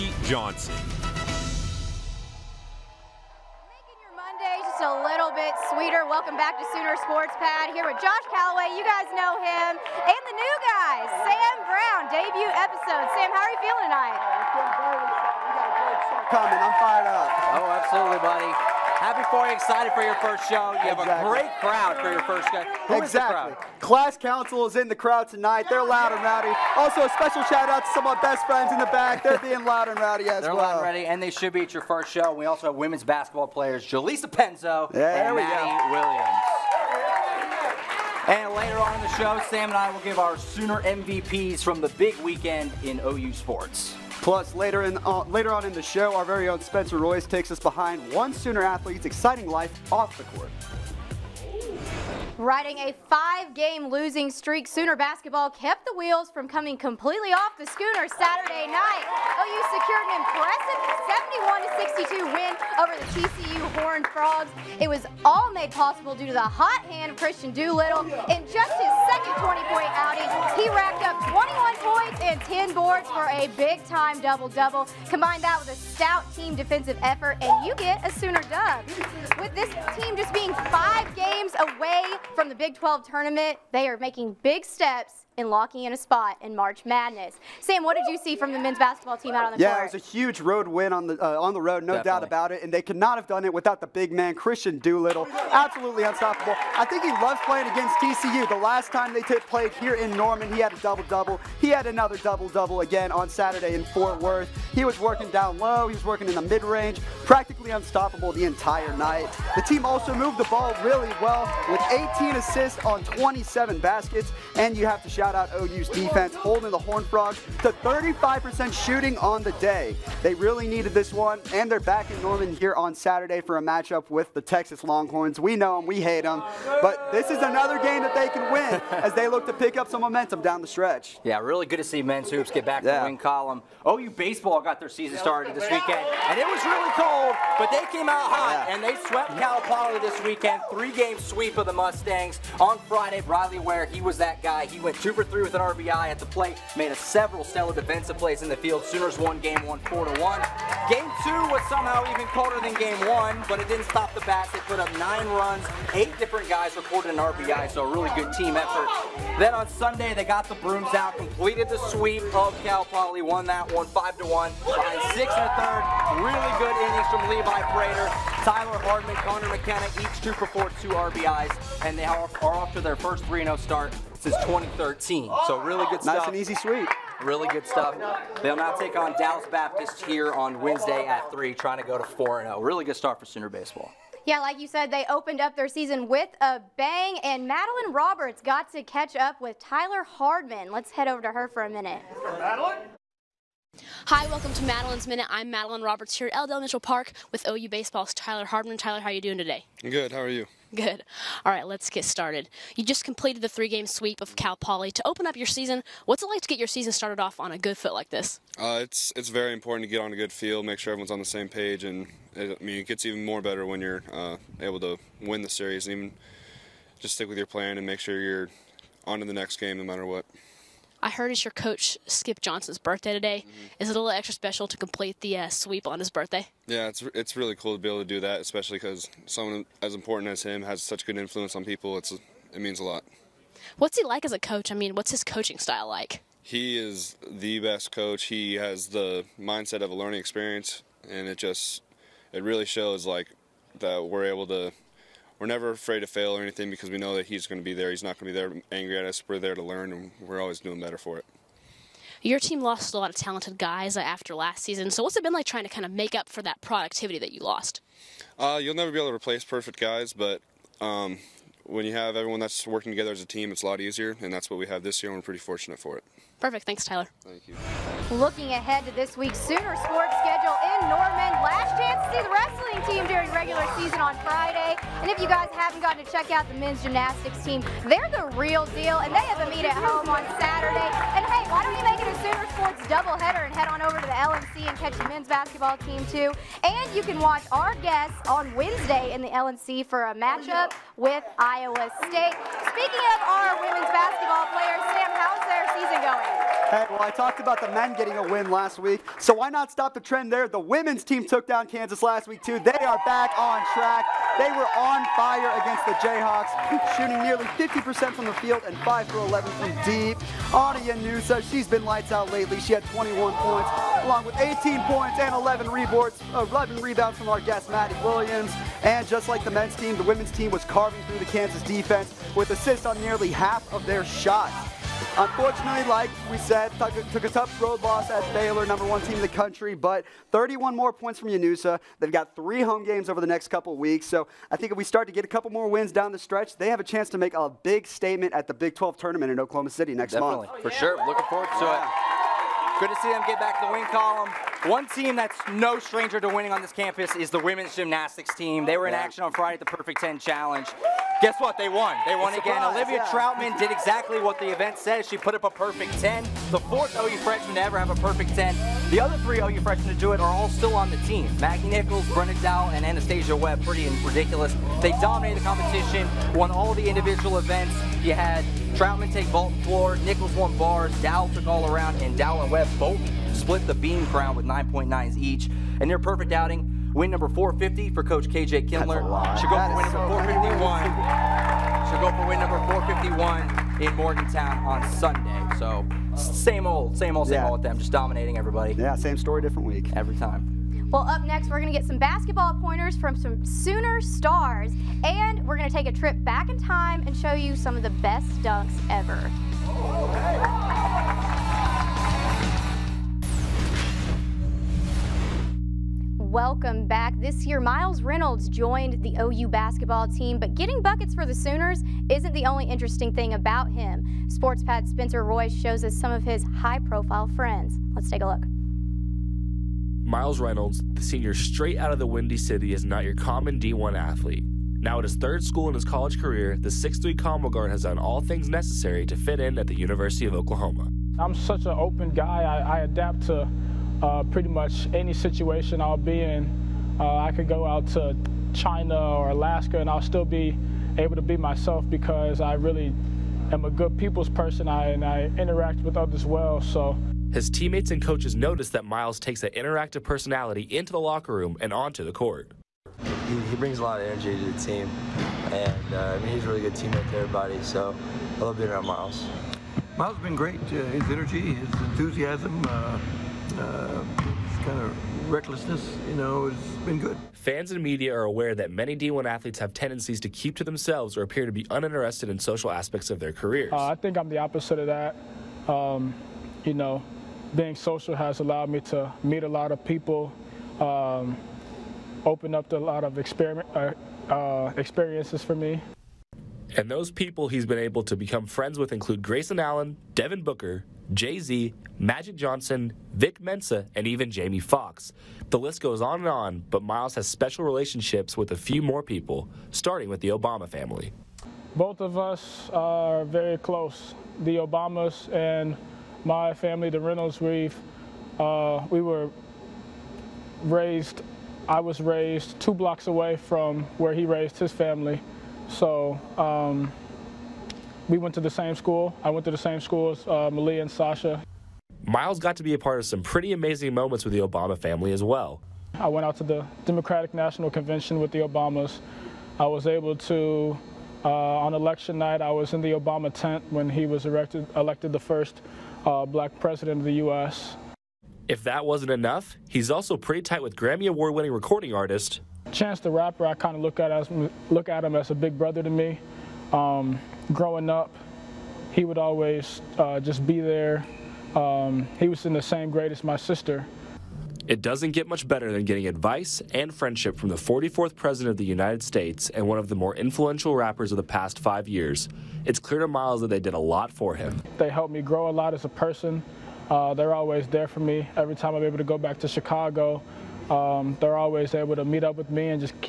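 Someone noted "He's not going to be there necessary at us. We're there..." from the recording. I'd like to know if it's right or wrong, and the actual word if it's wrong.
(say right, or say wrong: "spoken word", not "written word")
wrong: "angry", not "necessary".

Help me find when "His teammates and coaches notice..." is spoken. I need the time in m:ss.
7:27.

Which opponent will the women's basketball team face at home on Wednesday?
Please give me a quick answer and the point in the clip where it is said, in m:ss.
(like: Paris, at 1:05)
Iowa State, at 4:51.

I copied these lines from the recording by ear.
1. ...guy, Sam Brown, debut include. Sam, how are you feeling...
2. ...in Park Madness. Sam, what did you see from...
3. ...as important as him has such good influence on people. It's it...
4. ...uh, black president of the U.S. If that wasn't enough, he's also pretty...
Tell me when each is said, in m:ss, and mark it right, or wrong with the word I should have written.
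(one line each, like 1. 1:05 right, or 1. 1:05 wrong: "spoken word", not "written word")
1. 0:10 wrong: "episode", not "include"
2. 1:26 wrong: "March", not "Park"
3. 3:49 right
4. 8:56 right.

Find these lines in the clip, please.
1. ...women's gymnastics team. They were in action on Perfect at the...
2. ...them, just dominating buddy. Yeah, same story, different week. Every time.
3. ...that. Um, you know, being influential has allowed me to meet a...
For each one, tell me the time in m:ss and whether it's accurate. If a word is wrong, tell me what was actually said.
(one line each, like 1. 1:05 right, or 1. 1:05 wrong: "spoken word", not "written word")
1. 5:47 wrong: "Friday", not "Perfect"
2. 6:27 wrong: "everybody", not "buddy"
3. 7:54 wrong: "social", not "influential".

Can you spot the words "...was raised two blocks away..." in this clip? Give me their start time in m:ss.
8:31.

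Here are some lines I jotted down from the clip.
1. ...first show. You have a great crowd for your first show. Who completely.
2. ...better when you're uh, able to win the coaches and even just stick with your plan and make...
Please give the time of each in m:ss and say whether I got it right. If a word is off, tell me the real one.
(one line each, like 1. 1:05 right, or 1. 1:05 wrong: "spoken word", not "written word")
1. 0:20 wrong: "exactly", not "completely"
2. 3:33 wrong: "series", not "coaches".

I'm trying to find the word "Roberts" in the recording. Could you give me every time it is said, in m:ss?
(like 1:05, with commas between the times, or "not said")
3:07, 3:15.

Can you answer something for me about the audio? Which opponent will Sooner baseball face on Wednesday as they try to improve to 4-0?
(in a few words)
Dallas Baptist.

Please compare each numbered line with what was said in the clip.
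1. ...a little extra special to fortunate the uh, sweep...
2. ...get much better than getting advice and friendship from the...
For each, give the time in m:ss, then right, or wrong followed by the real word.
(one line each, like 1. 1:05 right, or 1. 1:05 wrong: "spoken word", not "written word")
1. 3:43 wrong: "complete", not "fortunate"
2. 9:15 right.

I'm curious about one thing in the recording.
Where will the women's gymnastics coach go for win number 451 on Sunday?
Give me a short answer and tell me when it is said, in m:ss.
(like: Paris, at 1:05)
Morgantown, at 6:23.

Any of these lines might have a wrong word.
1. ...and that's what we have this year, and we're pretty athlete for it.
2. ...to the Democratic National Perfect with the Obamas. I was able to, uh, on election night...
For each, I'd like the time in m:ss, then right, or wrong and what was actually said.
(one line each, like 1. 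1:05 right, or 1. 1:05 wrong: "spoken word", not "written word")
1. 4:24 wrong: "fortunate", not "athlete"
2. 8:46 wrong: "Convention", not "Perfect".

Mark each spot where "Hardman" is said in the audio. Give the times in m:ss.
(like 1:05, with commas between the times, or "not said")
2:48, 3:10, 3:18.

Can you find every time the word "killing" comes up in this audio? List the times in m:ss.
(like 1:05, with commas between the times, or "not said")
not said.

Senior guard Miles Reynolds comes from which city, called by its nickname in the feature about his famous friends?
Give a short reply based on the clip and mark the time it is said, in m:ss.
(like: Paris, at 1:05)
Windy City, at 7:02.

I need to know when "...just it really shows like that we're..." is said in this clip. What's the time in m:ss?
4:01.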